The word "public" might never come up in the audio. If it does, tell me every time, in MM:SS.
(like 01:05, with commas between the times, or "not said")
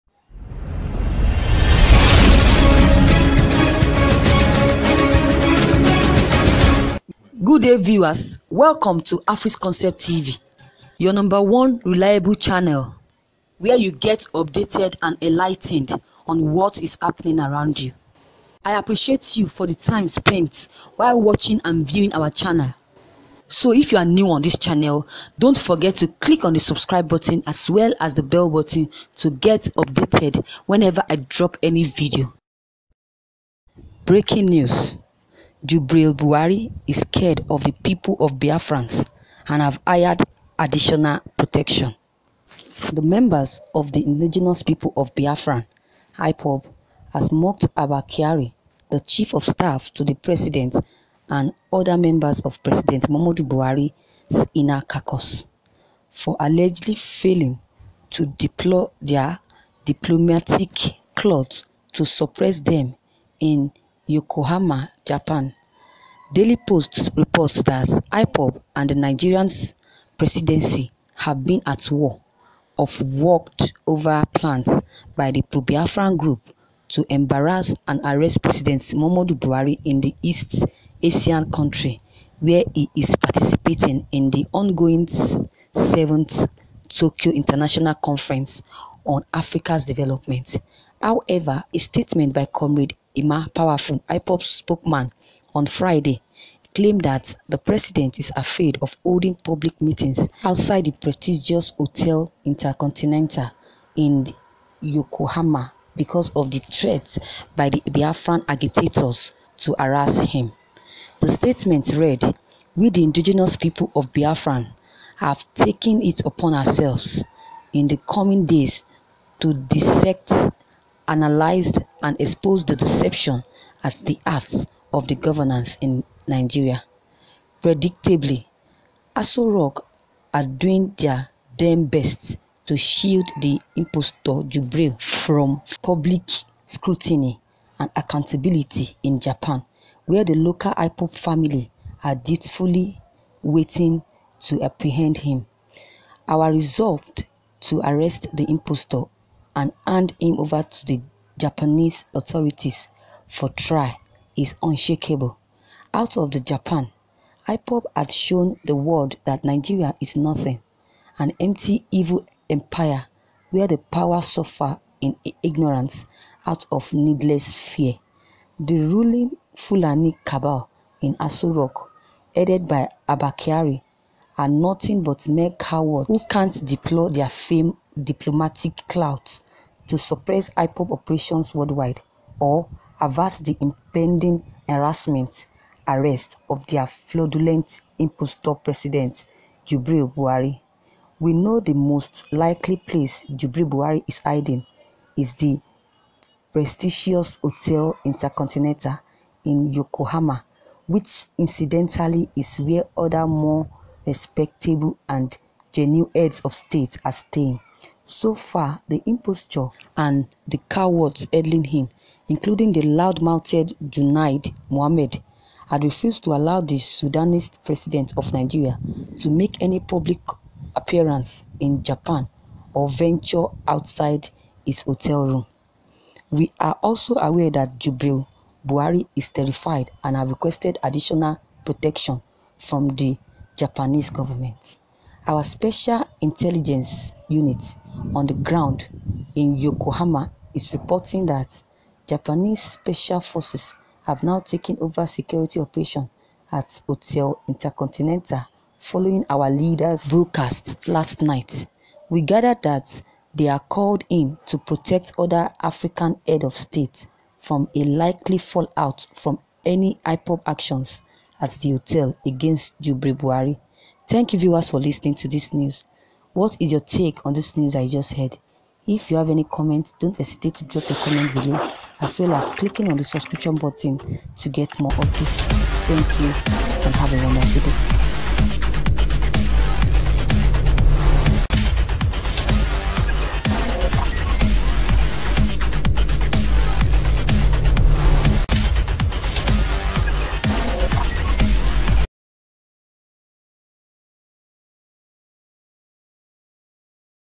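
01:39, 02:15, 03:39.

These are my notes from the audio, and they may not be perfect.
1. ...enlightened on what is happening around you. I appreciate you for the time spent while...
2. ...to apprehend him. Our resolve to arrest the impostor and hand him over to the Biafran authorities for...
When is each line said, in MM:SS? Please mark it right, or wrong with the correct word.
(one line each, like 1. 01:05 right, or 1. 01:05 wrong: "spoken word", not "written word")
1. 00:15 right
2. 02:24 wrong: "Japanese", not "Biafran".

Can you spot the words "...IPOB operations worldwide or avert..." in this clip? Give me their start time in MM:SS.
03:00.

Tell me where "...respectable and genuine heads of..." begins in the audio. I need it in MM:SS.
03:24.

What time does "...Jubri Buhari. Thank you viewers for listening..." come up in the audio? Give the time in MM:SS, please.
04:22.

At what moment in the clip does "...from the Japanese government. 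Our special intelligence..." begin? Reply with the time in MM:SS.
03:52.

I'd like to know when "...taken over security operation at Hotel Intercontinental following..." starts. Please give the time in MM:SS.
04:04.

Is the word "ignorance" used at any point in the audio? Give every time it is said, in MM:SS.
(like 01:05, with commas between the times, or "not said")
02:45.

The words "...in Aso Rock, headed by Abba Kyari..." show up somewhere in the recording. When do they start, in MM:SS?
02:51.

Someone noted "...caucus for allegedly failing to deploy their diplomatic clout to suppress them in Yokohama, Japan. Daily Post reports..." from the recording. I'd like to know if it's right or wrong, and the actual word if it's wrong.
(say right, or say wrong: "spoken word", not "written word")
right.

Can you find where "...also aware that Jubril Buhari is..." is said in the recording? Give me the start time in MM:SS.
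03:46.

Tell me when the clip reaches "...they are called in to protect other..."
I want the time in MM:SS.
04:13.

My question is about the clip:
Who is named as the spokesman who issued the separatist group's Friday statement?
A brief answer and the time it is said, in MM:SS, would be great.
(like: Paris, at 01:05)
Ima Power, at 01:33.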